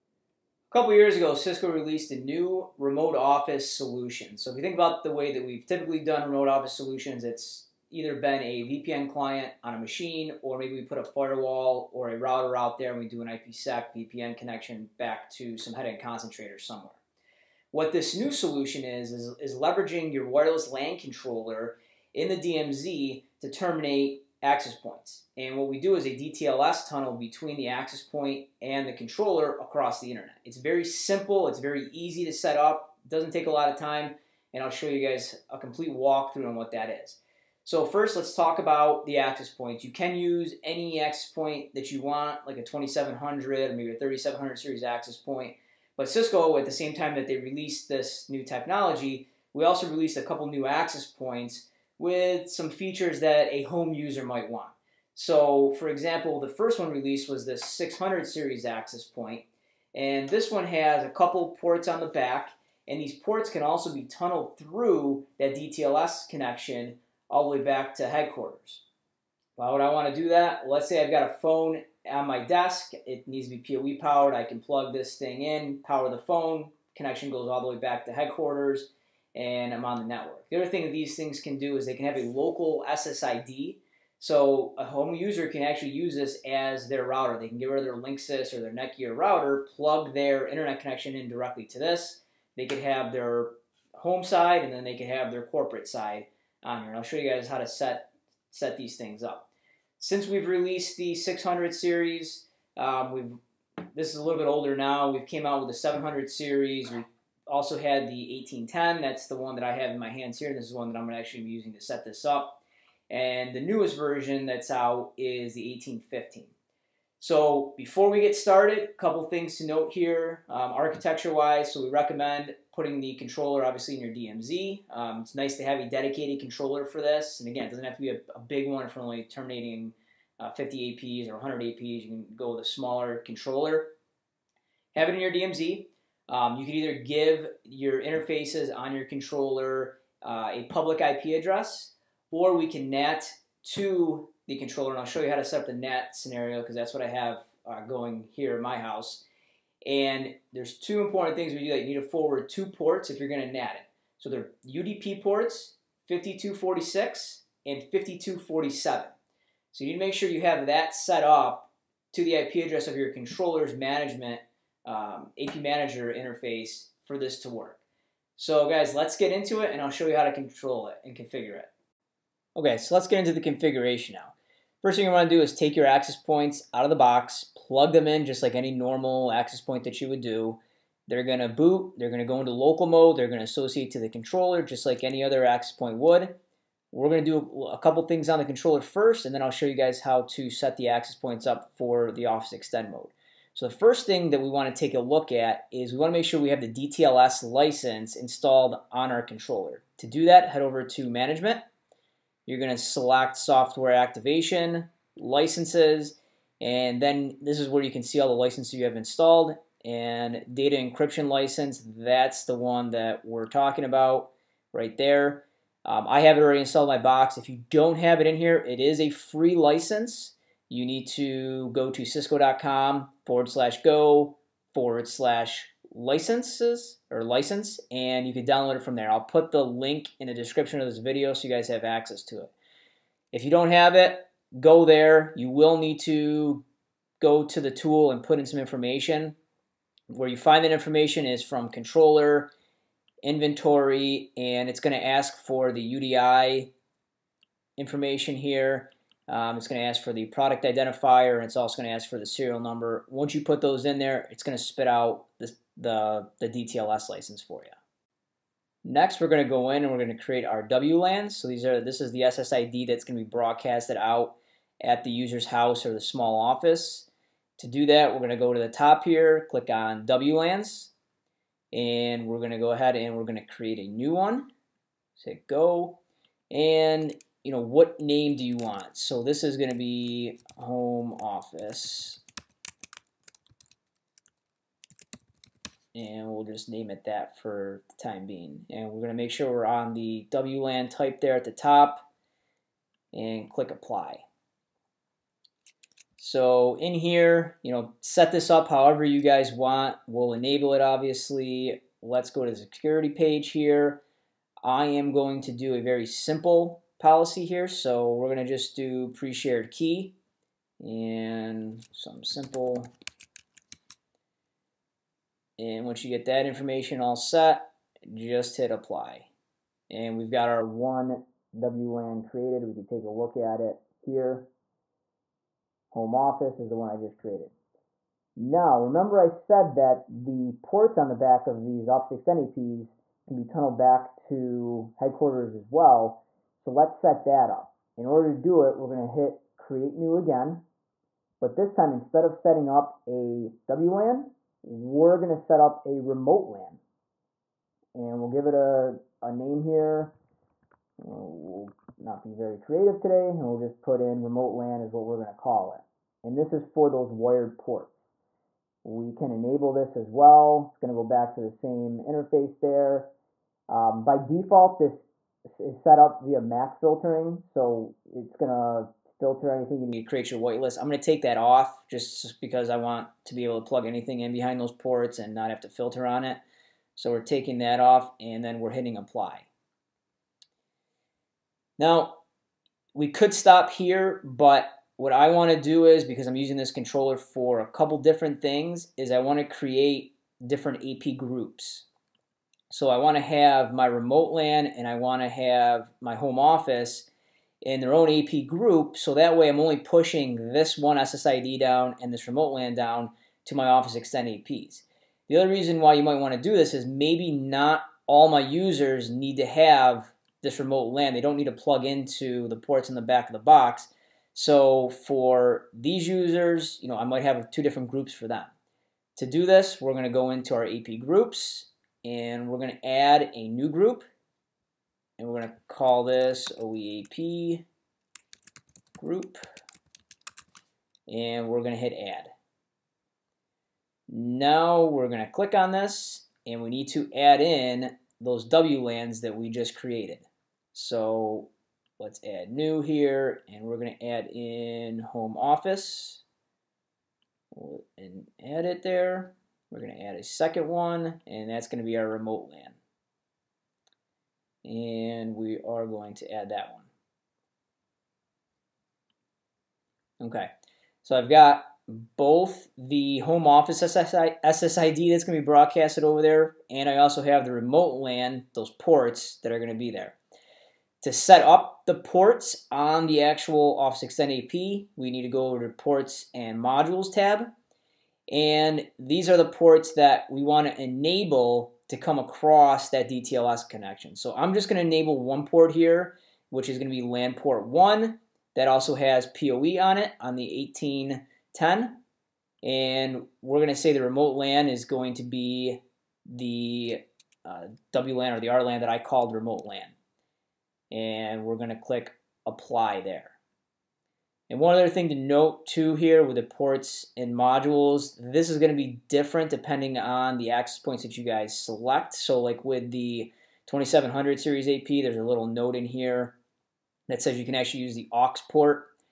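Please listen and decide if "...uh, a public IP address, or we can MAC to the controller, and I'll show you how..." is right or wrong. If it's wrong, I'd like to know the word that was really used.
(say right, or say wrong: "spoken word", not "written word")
wrong: "NAT", not "MAC".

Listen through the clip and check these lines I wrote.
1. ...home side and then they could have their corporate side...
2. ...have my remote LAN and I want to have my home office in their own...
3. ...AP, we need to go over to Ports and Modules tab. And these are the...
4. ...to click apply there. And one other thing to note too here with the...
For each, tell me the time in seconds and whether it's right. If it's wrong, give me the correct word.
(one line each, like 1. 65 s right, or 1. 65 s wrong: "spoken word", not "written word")
1. 93 s right
2. 393 s right
3. 474 s right
4. 501 s right.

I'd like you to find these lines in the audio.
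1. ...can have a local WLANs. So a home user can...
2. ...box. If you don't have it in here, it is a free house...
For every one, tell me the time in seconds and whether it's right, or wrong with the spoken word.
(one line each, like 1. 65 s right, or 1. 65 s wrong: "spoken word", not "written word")
1. 81 s wrong: "SSID", not "WLANs"
2. 217 s wrong: "license", not "house".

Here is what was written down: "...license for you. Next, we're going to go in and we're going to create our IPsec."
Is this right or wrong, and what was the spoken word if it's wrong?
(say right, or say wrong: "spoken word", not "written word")
wrong: "WLANs", not "IPsec".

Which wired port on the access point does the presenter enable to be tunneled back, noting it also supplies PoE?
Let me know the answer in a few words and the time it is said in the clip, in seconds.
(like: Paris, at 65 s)
LAN port 1, at 487 s.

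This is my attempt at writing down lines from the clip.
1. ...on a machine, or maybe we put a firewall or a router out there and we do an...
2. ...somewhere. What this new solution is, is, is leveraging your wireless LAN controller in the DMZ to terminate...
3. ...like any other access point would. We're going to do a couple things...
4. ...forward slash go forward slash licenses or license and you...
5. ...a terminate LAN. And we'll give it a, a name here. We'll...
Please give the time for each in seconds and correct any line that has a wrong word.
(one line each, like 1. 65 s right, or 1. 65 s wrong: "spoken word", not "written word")
1. 9 s right
2. 16 s right
3. 184 s right
4. 223 s right
5. 345 s wrong: "remote", not "terminate".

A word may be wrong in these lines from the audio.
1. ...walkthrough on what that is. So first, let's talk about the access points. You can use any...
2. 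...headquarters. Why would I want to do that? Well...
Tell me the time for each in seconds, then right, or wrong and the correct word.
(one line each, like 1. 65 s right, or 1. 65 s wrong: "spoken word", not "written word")
1. 35 s right
2. 68 s right.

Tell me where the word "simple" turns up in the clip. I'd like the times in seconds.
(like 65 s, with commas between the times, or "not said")
30 s, 306 s, 312 s.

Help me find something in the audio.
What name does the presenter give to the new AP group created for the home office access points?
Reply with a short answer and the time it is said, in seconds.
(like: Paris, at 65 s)
OEAP group, at 426 s.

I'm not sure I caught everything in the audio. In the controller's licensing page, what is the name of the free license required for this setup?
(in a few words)
Data Encryption License.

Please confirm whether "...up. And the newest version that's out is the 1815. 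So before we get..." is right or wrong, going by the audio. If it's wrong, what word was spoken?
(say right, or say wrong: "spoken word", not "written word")
right.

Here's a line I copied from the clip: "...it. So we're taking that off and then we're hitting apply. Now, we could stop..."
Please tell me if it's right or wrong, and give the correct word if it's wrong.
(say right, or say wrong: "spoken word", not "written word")
right.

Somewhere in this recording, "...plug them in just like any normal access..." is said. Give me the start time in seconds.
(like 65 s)
177 s.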